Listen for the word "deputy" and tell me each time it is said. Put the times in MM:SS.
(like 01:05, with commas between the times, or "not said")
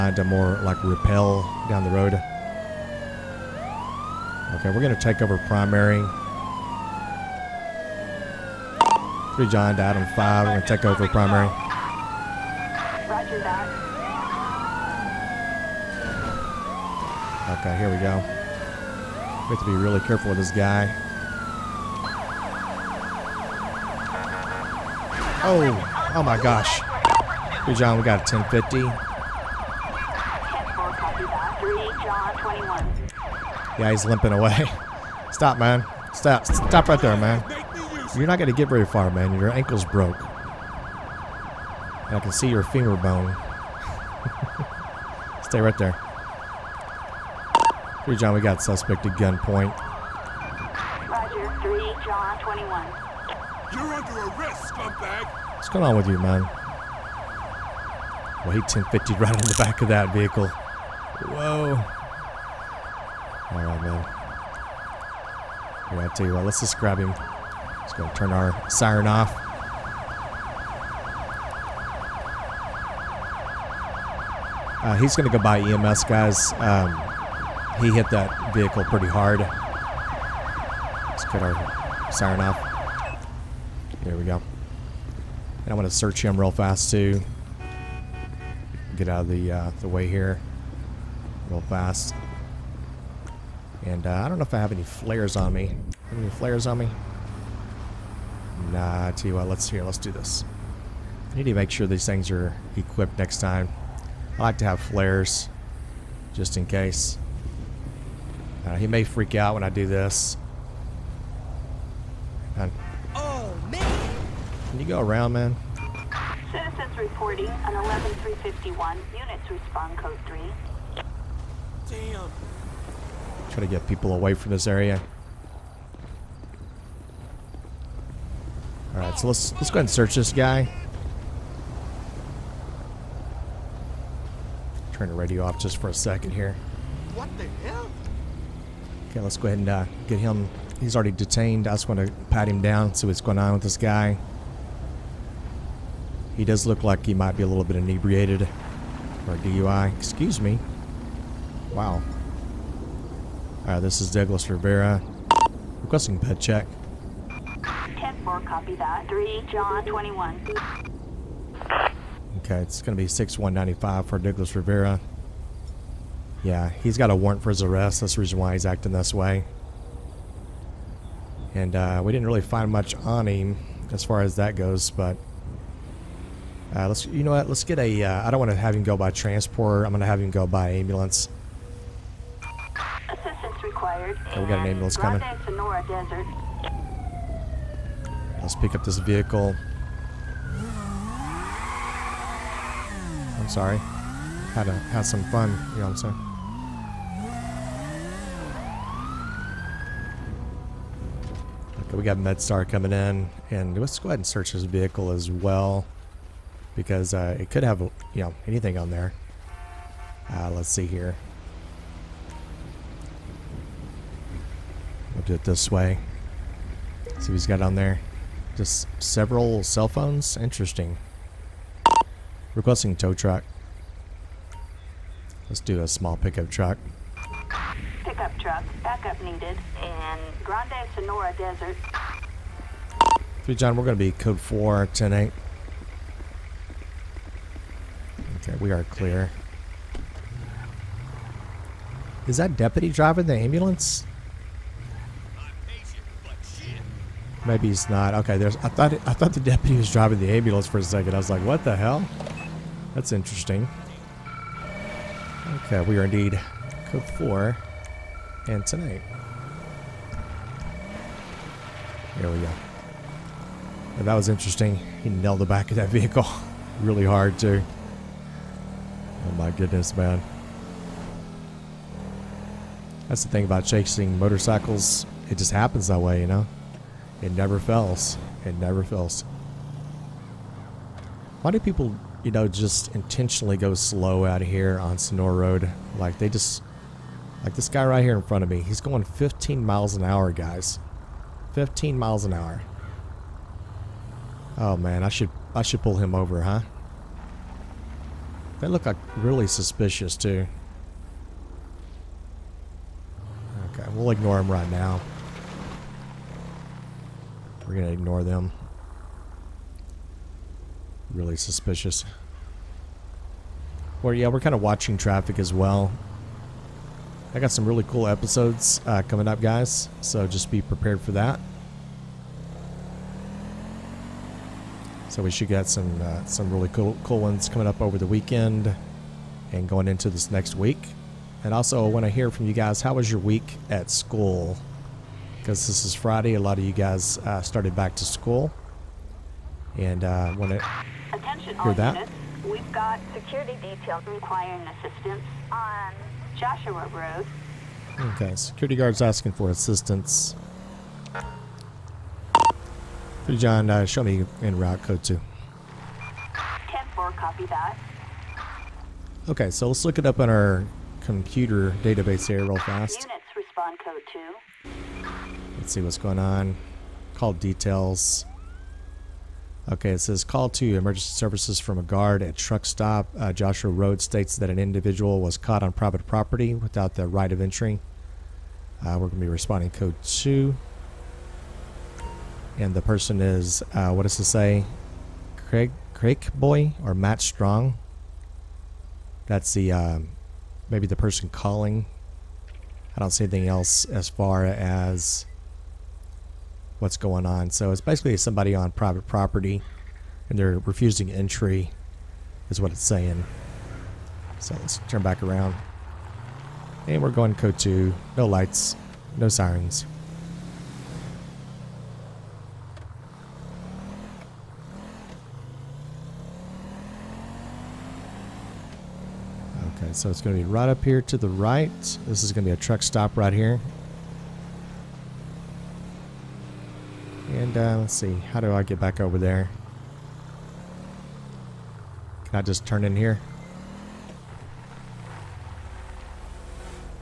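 04:02, 04:09.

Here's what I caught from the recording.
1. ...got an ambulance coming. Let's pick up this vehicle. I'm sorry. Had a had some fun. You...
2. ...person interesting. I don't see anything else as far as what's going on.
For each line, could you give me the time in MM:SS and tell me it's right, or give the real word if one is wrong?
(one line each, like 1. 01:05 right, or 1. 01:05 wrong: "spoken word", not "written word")
1. 03:04 right
2. 06:30 wrong: "calling", not "interesting".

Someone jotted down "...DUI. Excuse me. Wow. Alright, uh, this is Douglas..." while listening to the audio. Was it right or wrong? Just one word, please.
right.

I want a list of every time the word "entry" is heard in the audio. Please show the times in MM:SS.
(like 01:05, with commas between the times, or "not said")
06:17, 06:41.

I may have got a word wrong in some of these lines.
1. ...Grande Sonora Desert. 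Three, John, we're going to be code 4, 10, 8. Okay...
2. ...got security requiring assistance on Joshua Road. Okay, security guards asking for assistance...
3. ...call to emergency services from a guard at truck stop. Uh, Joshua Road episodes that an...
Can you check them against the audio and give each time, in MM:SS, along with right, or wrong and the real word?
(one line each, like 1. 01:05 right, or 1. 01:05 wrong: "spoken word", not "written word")
1. 03:50 right
2. 05:42 right
3. 06:10 wrong: "states", not "episodes".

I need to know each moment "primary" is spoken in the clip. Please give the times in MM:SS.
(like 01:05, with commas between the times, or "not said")
00:05, 00:11.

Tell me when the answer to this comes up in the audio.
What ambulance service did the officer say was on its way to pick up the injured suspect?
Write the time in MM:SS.
03:22.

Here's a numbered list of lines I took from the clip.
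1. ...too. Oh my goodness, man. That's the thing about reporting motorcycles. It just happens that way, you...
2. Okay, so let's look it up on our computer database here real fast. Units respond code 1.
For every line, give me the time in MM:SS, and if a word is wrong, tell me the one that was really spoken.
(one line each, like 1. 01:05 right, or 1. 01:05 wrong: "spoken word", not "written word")
1. 04:27 wrong: "chasing", not "reporting"
2. 05:59 wrong: "2", not "1".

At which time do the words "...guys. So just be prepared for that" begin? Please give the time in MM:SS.
05:19.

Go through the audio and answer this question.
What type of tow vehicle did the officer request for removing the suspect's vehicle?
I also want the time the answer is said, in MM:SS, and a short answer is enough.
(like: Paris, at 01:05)
small pickup truck, at 03:45.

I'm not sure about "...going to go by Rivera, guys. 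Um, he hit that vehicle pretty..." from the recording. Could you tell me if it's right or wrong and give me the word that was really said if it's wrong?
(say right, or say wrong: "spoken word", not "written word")
wrong: "EMS", not "Rivera".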